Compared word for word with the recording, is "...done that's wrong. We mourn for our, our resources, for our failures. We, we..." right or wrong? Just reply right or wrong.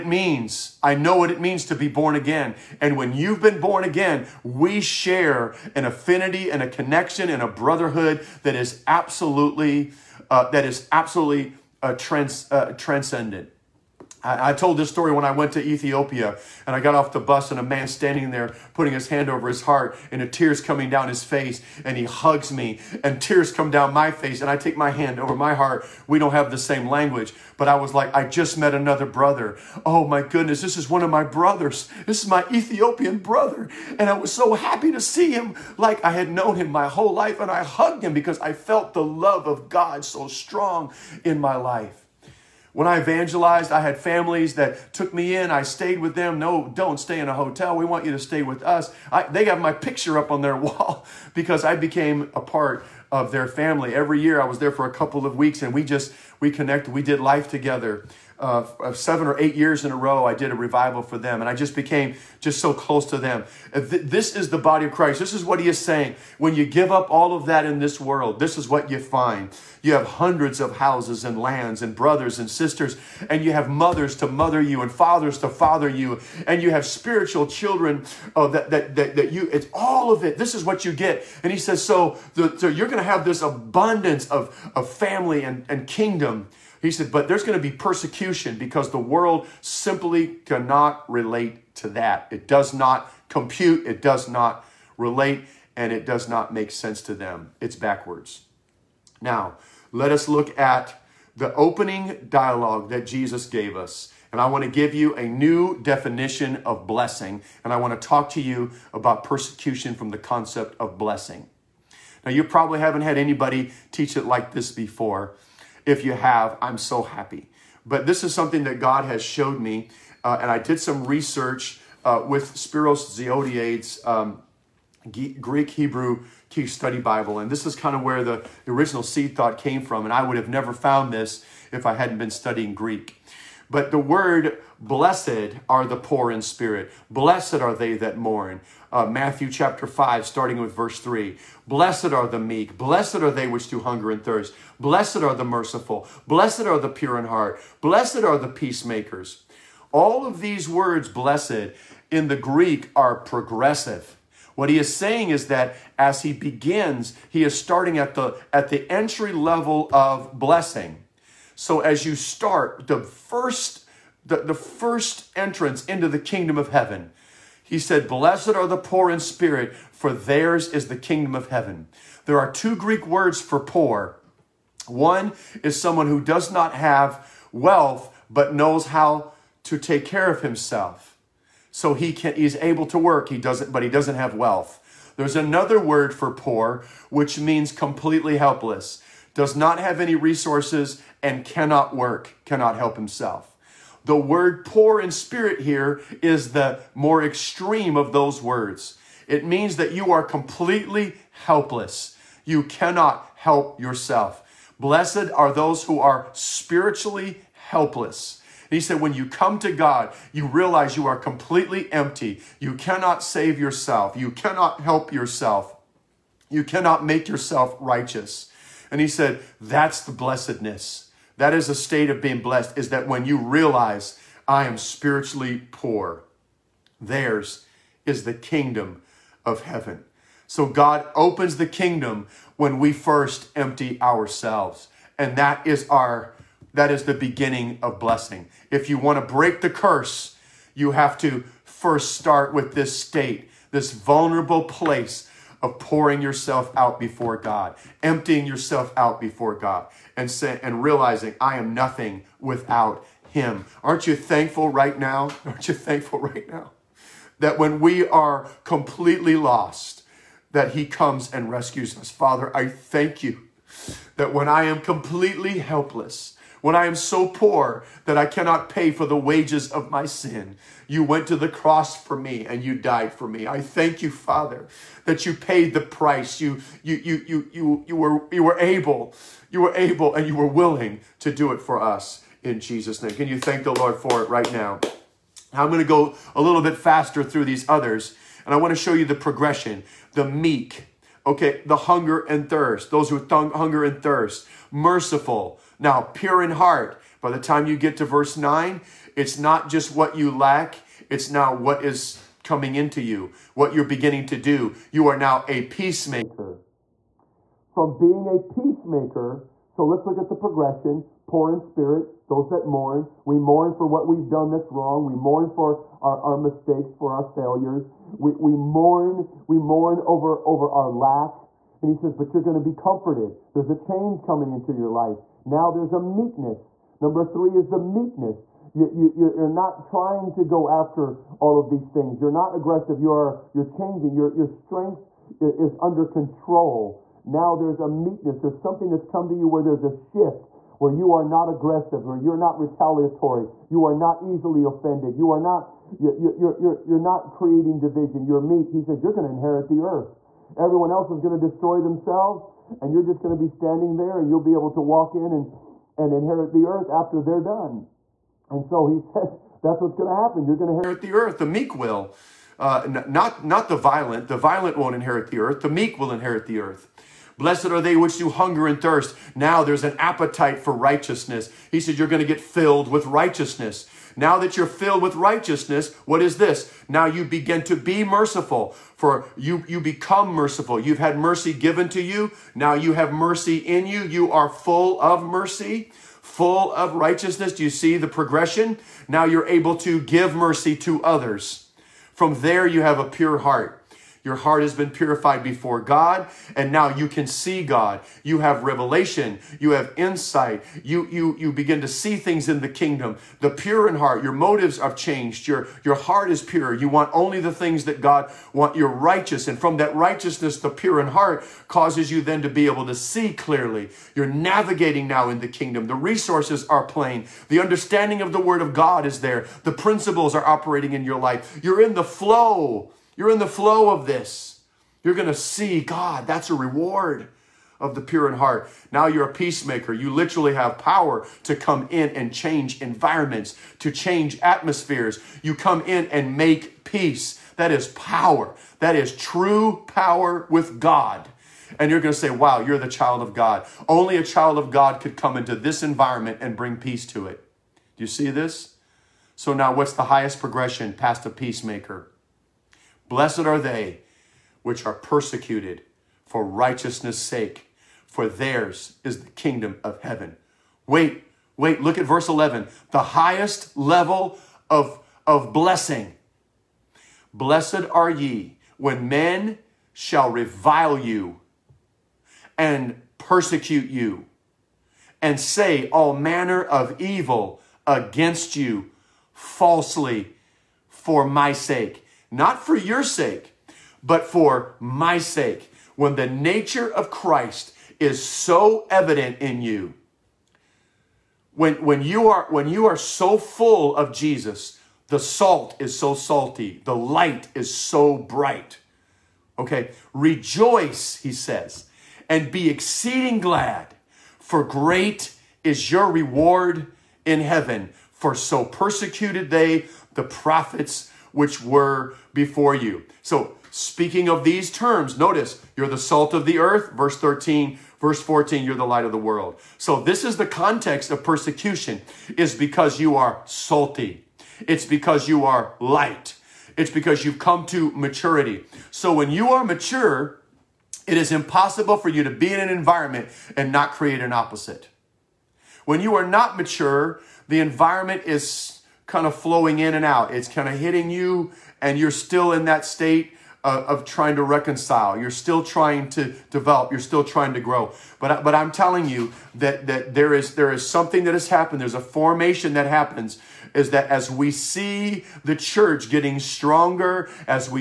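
wrong.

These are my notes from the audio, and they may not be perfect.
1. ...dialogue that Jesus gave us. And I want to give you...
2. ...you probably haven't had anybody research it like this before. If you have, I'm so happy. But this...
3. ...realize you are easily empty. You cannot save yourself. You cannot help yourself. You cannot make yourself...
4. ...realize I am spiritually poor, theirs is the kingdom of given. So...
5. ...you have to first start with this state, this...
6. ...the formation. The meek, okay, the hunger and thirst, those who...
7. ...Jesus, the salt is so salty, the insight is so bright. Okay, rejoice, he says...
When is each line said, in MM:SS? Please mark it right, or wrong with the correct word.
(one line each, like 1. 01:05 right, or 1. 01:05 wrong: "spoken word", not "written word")
1. 01:42 right
2. 01:52 wrong: "teach", not "research"
3. 03:30 wrong: "completely", not "easily"
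4. 03:43 wrong: "heaven", not "given"
5. 04:00 right
6. 04:49 wrong: "progression", not "formation"
7. 08:14 wrong: "light", not "insight".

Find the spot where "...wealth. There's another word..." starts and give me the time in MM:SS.
03:04.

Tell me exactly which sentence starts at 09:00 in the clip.
It's kind of hitting you, and you're still in that state of, uh, of trying to reconcile.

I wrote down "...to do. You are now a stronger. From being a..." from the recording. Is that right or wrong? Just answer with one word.
wrong.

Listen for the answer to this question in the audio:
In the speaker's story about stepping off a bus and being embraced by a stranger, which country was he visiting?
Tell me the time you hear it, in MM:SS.
00:15.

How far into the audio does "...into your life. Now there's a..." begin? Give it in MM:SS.
05:24.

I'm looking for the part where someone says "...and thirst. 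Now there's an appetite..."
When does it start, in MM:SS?
06:08.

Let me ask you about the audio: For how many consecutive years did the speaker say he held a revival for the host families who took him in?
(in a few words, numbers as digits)
7 or 8.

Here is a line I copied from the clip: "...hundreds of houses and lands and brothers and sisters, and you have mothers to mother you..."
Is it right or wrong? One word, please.
right.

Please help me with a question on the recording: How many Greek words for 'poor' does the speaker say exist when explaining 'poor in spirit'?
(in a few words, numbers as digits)
2.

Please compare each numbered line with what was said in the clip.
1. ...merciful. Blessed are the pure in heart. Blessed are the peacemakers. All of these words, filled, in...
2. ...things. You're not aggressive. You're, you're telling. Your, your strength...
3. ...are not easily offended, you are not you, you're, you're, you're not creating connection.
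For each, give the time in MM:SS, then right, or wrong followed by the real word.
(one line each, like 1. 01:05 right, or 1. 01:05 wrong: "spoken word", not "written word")
1. 02:25 wrong: "blessed", not "filled"
2. 05:31 wrong: "changing", not "telling"
3. 05:43 wrong: "division", not "connection".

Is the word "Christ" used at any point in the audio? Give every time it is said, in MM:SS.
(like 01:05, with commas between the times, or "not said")
01:04, 08:07.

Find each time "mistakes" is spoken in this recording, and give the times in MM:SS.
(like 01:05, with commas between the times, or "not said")
05:16.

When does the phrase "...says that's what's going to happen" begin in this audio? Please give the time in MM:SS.
05:58.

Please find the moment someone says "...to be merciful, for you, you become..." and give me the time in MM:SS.
06:17.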